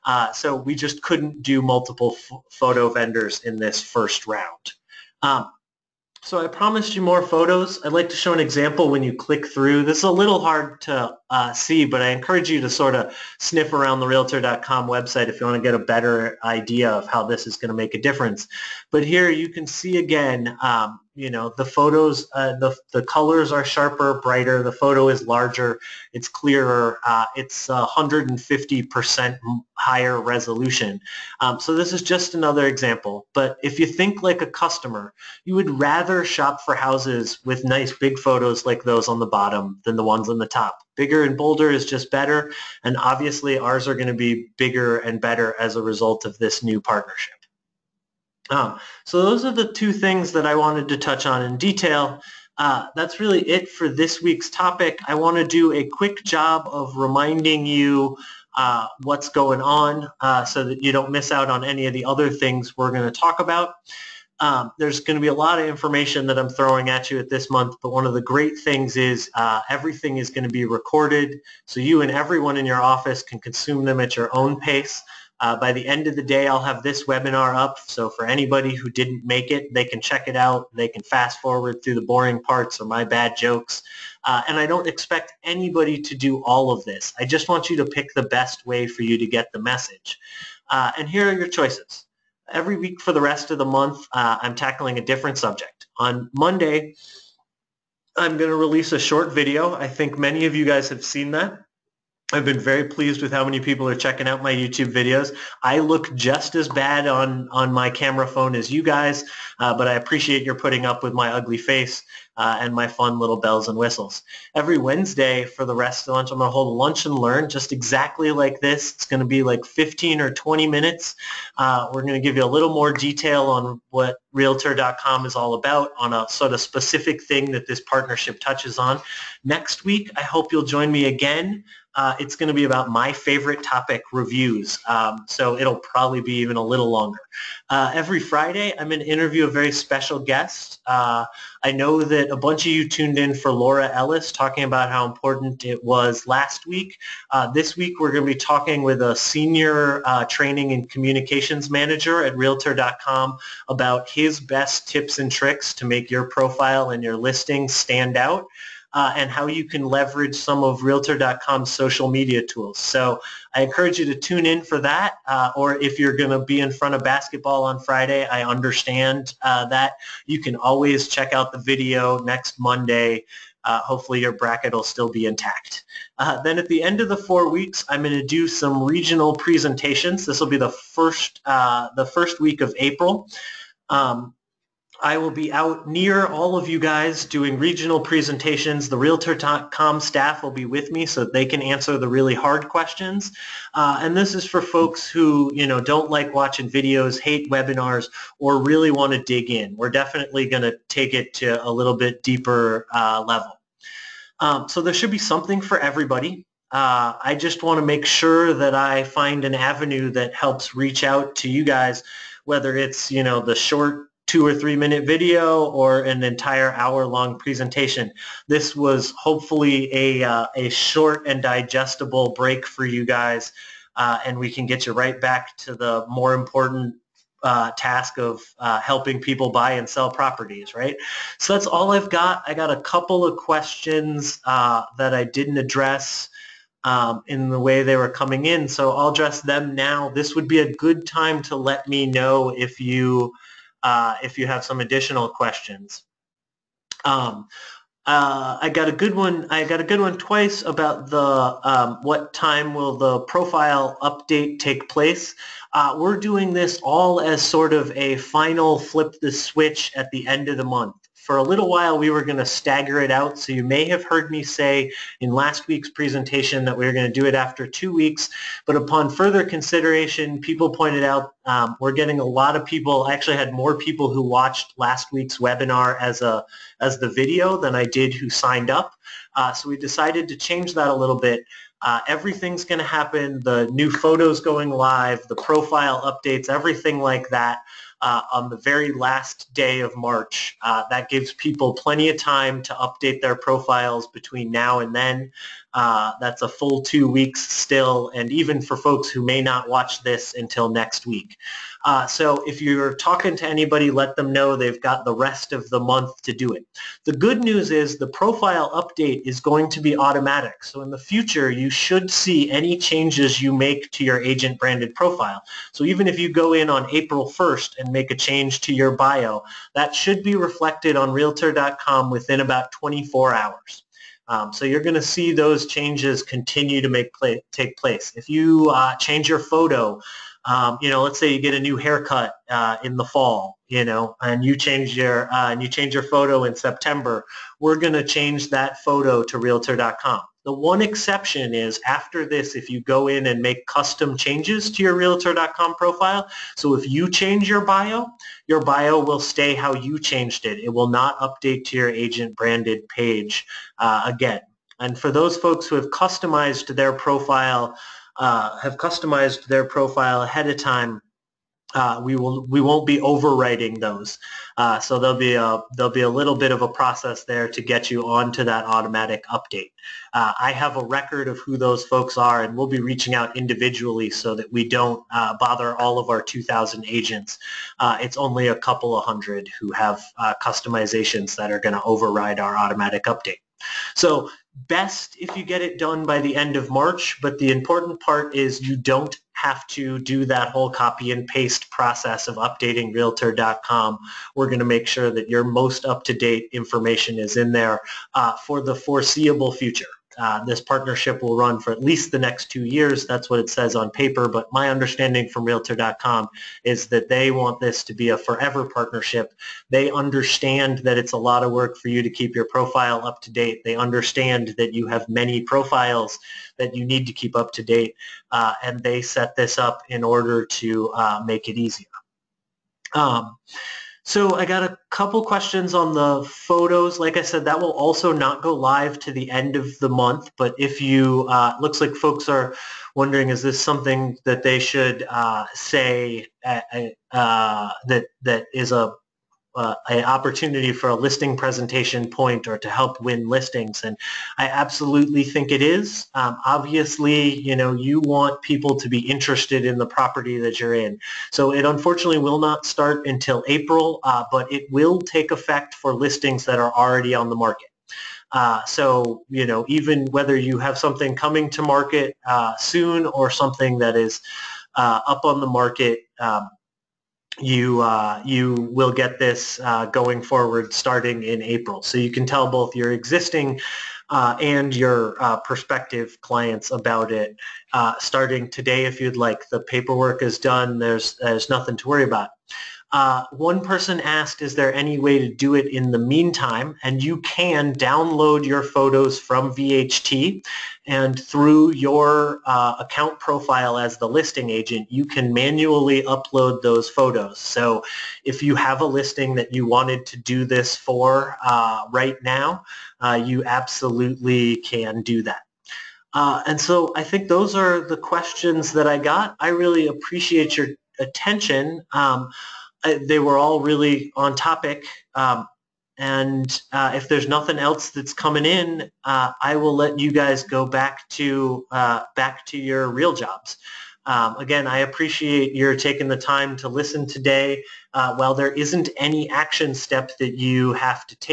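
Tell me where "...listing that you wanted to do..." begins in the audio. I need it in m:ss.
8:18.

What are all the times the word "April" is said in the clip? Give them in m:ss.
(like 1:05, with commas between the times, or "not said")
3:02, 5:16, 7:33, 7:51.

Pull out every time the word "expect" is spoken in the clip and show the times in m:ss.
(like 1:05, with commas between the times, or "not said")
1:24.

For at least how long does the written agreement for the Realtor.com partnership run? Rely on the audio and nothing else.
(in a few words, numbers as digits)
2 years.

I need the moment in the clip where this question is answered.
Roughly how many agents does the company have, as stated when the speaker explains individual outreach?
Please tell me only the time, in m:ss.
6:16.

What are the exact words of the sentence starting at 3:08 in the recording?
The Realtor.com staff will be with me so they can answer the really hard questions.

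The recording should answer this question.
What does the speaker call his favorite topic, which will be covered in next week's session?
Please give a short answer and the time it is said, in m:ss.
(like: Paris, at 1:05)
Reviews, at 2:14.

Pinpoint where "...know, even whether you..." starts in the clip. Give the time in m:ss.
7:39.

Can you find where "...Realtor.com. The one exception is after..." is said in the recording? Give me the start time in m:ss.
5:39.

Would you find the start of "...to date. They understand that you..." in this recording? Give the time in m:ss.
6:53.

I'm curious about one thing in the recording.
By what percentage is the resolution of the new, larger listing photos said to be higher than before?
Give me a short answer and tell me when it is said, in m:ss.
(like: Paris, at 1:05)
150 percent, at 0:27.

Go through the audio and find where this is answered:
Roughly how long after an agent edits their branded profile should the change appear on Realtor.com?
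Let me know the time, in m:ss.
5:22.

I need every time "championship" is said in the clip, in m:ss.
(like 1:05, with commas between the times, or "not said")
not said.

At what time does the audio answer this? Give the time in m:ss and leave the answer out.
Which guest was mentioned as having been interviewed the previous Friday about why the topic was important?
2:23.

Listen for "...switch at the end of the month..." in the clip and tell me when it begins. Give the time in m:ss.
4:19.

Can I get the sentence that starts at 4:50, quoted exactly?
Uh, that gives people plenty of time to update their profiles between now and then.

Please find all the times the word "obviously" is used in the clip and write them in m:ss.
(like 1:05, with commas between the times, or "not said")
0:42, 7:26.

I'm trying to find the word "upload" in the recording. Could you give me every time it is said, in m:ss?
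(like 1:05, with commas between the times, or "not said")
8:16.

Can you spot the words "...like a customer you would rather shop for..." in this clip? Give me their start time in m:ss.
0:34.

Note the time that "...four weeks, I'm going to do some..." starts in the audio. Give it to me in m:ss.
2:57.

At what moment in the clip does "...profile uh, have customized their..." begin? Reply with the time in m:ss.
5:56.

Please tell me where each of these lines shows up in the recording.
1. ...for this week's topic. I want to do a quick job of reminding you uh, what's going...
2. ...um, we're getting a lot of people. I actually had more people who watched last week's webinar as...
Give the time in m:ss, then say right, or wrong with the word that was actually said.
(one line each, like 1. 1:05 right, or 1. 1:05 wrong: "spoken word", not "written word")
1. 0:53 right
2. 4:31 right.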